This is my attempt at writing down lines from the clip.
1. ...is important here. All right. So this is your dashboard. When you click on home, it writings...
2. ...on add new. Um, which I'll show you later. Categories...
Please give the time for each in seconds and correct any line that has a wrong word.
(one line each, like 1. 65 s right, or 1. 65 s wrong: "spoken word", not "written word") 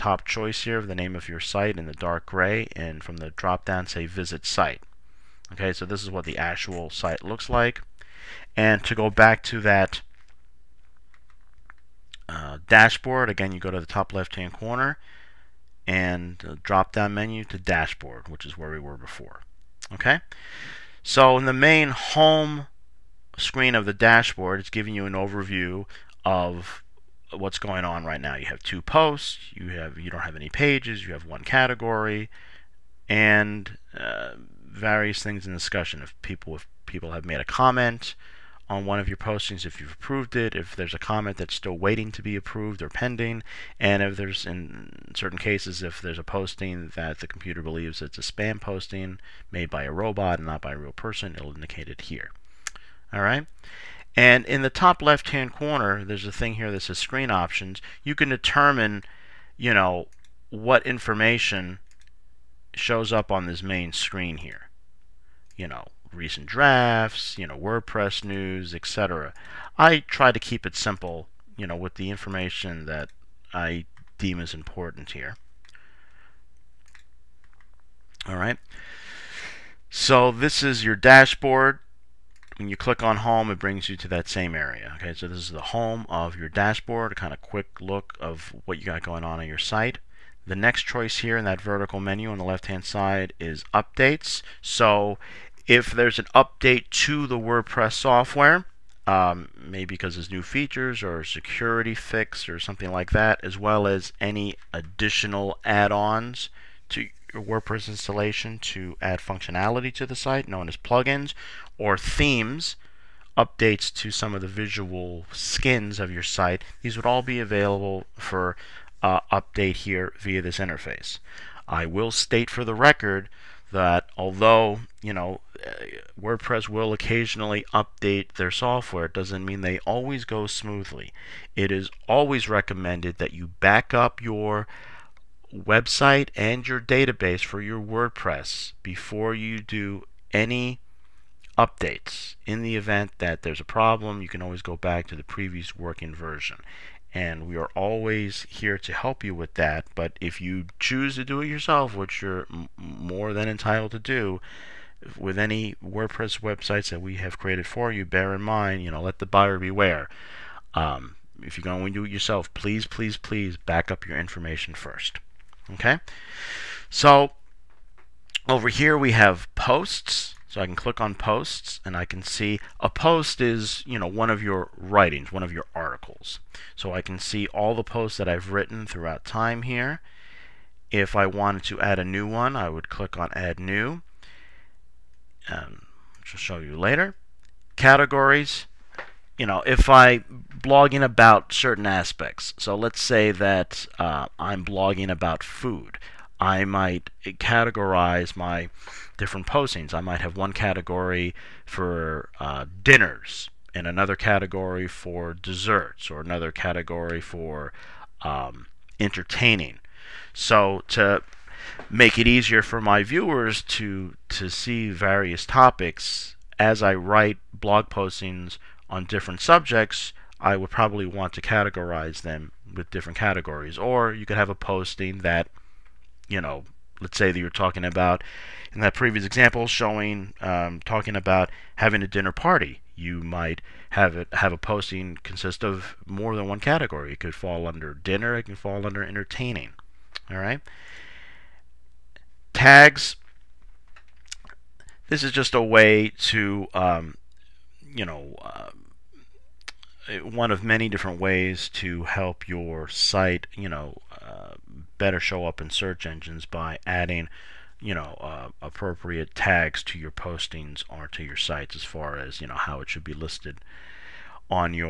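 1. 74 s wrong: "brings", not "writings"
2. 183 s right.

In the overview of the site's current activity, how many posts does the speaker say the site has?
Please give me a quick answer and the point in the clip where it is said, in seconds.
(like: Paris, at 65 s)
2, at 28 s.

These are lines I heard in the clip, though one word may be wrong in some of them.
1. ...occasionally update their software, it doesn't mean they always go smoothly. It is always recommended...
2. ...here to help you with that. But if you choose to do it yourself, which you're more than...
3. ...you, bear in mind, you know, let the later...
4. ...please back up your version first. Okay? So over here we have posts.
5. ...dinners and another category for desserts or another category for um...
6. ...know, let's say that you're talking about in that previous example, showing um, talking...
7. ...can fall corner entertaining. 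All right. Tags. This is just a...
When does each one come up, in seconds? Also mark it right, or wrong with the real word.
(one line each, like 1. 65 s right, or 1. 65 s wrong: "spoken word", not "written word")
1. 126 s right
2. 148 s right
3. 157 s wrong: "buyer", not "later"
4. 163 s wrong: "information", not "version"
5. 202 s right
6. 226 s right
7. 238 s wrong: "under", not "corner".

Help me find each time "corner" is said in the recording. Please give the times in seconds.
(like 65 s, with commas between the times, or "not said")
14 s, 55 s.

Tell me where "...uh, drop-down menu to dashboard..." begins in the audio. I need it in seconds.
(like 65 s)
16 s.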